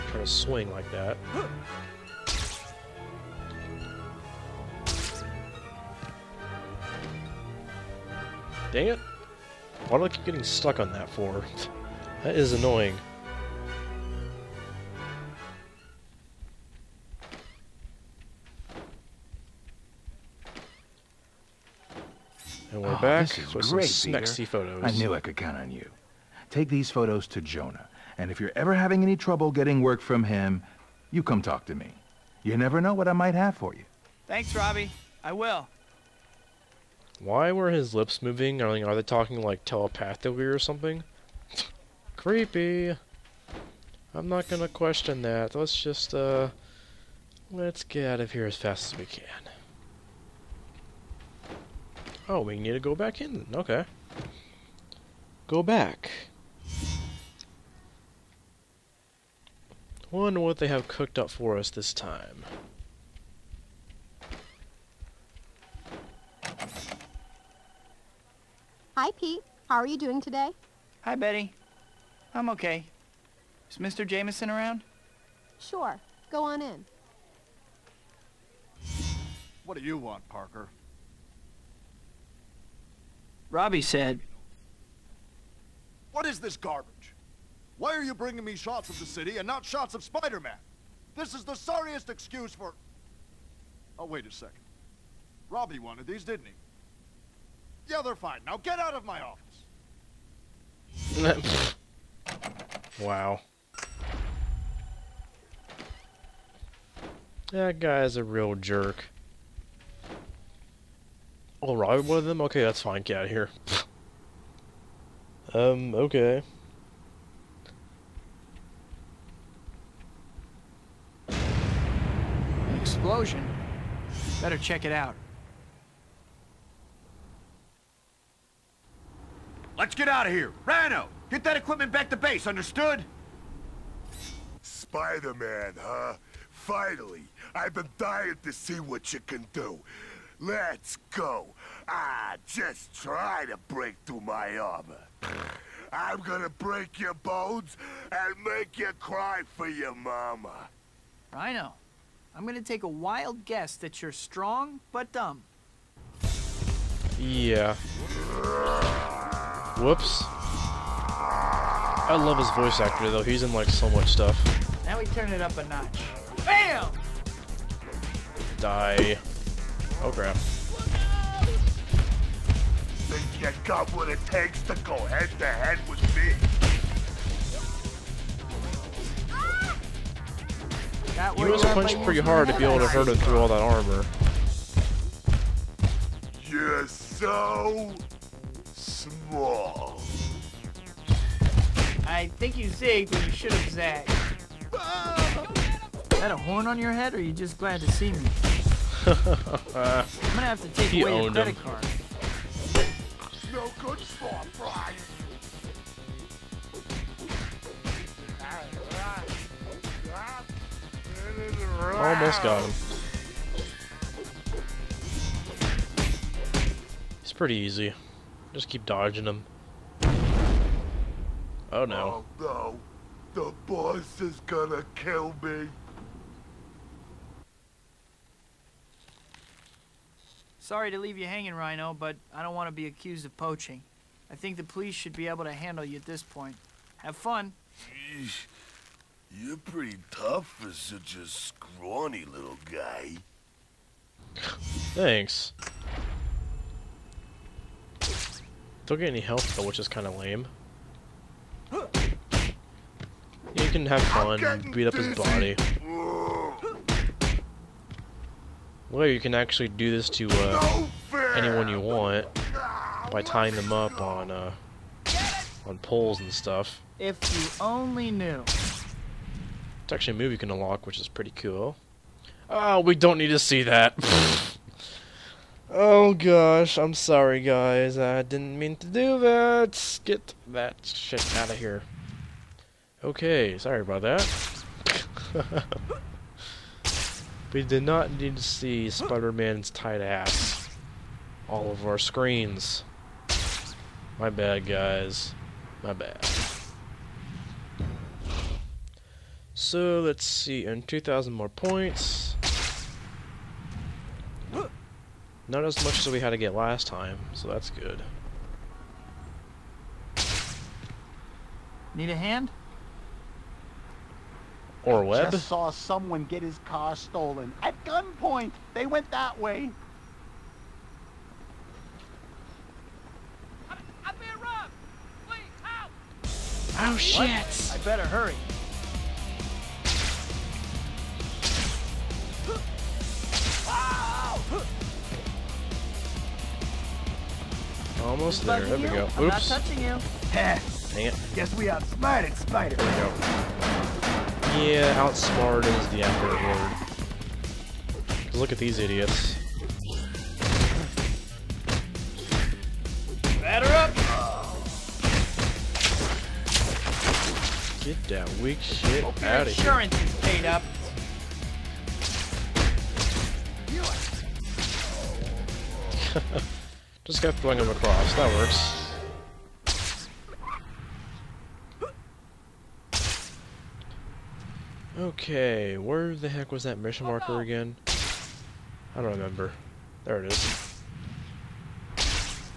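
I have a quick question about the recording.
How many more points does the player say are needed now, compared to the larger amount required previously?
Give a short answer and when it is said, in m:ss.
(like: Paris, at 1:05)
2,000, at 5:00.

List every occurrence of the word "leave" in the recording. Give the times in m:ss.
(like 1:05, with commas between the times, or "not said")
3:50.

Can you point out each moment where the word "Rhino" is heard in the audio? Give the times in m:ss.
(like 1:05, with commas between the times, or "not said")
2:10, 2:31, 3:51.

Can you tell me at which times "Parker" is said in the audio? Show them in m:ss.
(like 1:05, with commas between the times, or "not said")
1:20.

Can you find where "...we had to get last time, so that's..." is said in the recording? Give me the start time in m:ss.
5:06.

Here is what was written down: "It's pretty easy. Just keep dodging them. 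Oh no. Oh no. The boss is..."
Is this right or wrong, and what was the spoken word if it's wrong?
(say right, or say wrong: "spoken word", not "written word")
right.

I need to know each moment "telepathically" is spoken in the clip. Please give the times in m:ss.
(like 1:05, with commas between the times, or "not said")
0:39.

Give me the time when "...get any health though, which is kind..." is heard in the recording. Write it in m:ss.
4:08.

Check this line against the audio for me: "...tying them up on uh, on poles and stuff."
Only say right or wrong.
right.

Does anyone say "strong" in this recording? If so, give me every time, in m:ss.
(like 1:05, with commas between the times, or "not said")
2:34.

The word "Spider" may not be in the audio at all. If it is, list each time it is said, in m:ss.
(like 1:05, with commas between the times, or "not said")
1:30, 2:14, 4:48, 5:42.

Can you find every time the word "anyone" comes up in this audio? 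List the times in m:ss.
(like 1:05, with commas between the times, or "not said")
4:21.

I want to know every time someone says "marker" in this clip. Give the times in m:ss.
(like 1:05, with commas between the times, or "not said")
6:17.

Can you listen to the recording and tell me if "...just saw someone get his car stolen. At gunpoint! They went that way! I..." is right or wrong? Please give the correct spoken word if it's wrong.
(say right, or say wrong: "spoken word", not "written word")
right.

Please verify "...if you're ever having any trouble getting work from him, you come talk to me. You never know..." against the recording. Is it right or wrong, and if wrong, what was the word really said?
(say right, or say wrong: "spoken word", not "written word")
right.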